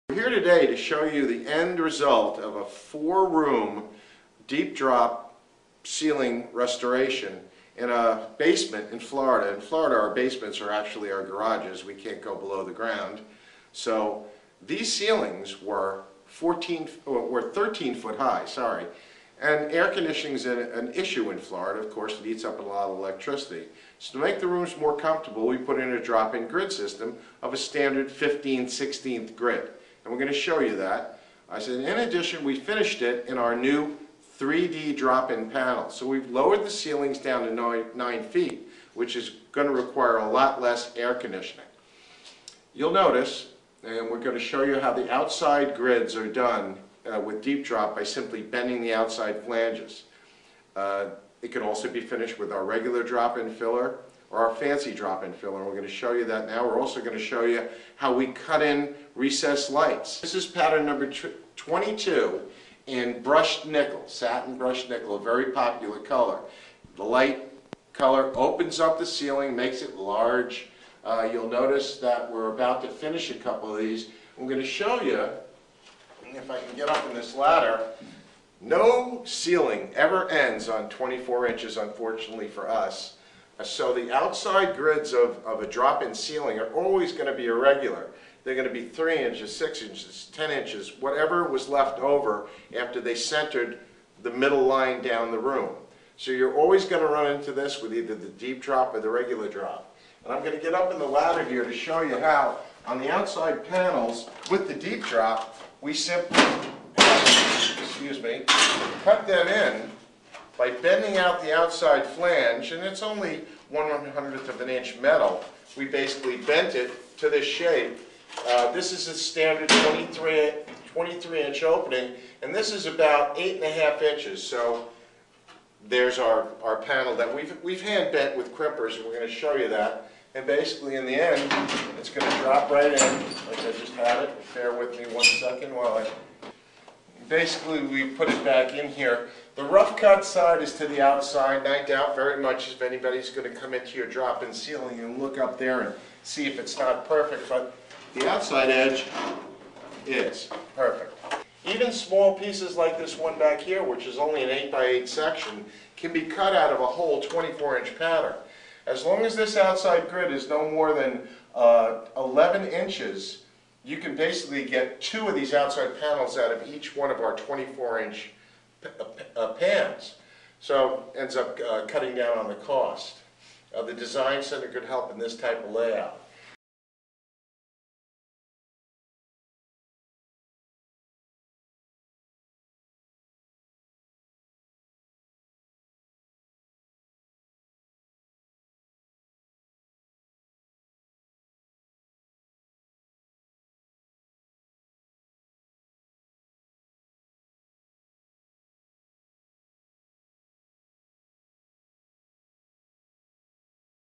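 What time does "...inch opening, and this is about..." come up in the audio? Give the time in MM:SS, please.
02:01.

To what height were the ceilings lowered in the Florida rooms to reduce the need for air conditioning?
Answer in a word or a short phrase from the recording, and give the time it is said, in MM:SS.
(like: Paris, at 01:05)
9 feet, at 00:37.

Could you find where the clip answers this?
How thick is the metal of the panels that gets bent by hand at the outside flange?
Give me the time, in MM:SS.
01:53.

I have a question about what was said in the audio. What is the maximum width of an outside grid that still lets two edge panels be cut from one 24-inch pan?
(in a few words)
11 inches.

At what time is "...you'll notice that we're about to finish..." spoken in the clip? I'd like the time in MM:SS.
01:11.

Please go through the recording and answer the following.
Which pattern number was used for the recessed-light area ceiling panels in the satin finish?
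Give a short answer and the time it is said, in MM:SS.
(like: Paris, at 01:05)
22, at 01:00.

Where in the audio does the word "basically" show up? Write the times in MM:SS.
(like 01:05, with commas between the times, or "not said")
01:55, 02:10, 02:17, 02:44.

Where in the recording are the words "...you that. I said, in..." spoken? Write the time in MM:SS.
00:30.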